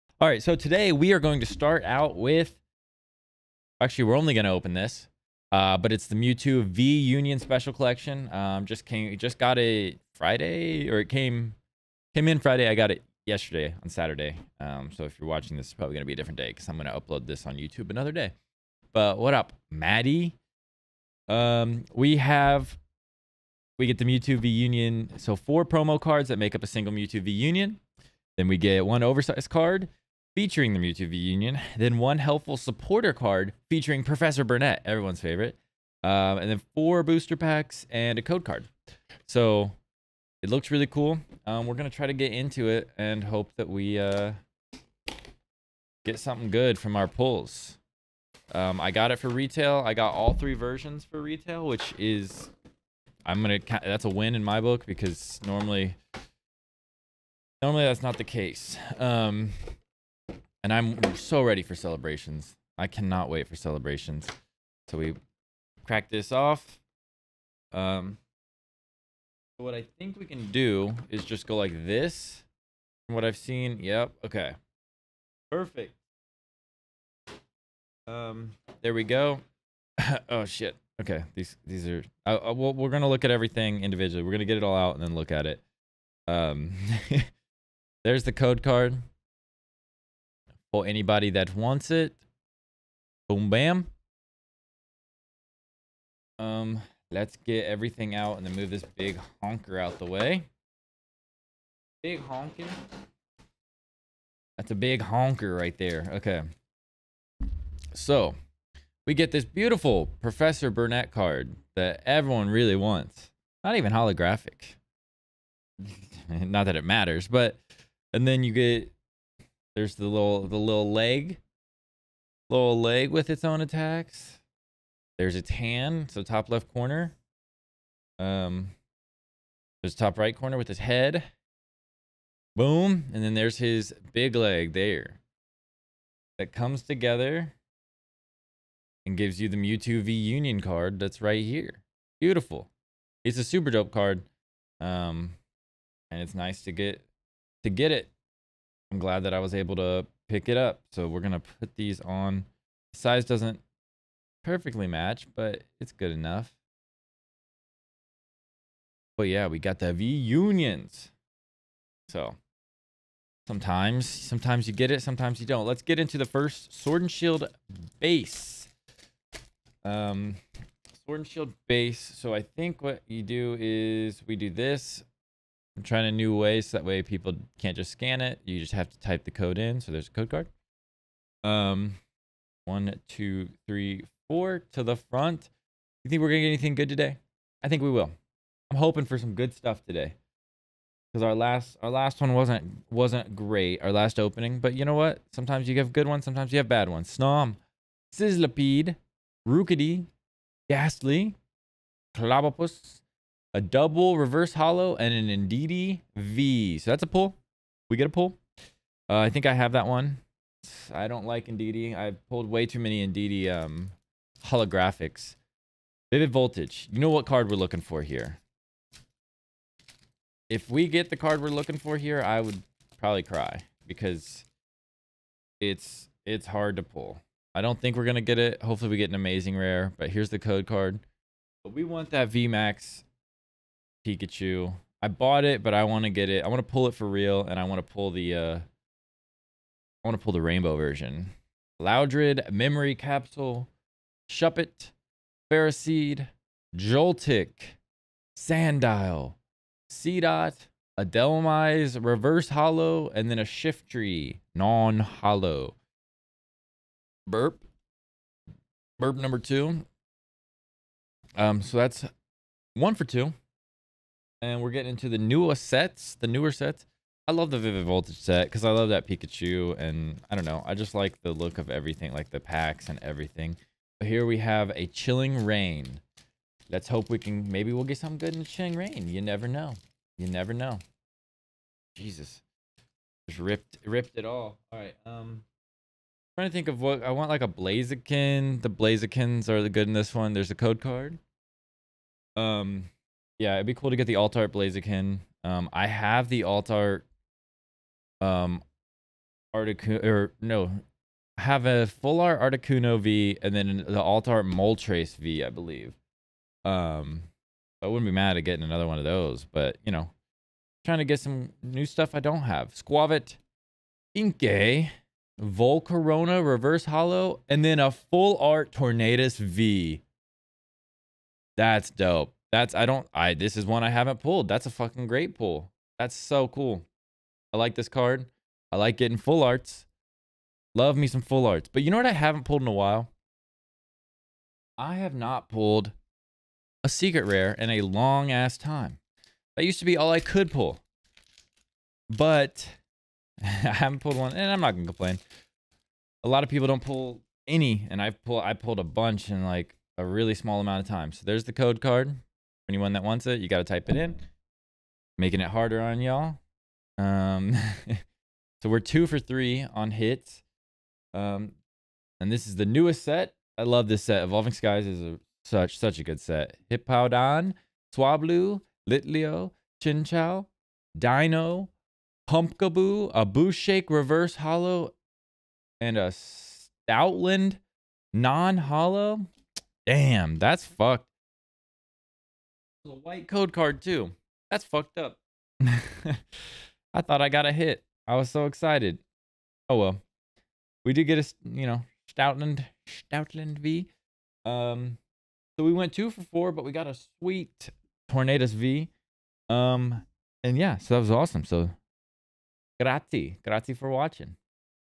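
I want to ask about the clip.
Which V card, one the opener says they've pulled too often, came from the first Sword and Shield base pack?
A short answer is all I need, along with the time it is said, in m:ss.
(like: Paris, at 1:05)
Indeedee V, at 3:25.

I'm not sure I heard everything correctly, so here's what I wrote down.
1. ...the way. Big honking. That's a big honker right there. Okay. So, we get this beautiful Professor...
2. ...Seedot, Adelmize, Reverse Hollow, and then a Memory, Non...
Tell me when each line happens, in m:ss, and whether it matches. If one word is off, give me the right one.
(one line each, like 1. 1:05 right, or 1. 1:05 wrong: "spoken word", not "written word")
1. 1:39 right
2. 4:09 wrong: "Shiftry", not "Memory".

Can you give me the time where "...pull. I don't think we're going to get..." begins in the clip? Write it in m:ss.
3:46.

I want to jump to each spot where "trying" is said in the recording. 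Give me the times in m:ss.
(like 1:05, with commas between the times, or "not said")
2:55, 4:46, 5:10.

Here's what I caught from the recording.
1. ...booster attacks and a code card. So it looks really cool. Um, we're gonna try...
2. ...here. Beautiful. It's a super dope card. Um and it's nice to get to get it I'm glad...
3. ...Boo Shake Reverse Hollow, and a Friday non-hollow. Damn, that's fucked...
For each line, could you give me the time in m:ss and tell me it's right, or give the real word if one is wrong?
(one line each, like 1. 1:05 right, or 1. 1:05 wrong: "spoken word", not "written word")
1. 0:37 wrong: "packs", not "attacks"
2. 2:21 right
3. 6:13 wrong: "Stoutland", not "Friday".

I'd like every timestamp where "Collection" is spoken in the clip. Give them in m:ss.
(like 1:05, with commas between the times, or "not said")
0:07.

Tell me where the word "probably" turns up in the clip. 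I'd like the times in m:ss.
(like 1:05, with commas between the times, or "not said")
0:15, 3:42.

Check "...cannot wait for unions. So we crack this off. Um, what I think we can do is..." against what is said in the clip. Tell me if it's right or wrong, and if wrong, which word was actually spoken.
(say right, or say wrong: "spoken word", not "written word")
wrong: "celebrations", not "unions".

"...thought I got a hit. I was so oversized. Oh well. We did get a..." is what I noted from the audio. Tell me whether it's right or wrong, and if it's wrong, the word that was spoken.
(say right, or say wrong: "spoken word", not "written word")
wrong: "excited", not "oversized".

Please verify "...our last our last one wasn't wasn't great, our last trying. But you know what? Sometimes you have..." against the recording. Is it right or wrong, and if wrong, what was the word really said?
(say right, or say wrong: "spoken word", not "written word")
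wrong: "opening", not "trying".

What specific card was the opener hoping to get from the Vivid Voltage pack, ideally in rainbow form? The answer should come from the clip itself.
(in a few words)
VMAX Pikachu.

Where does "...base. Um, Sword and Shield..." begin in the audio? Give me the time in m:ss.
2:47.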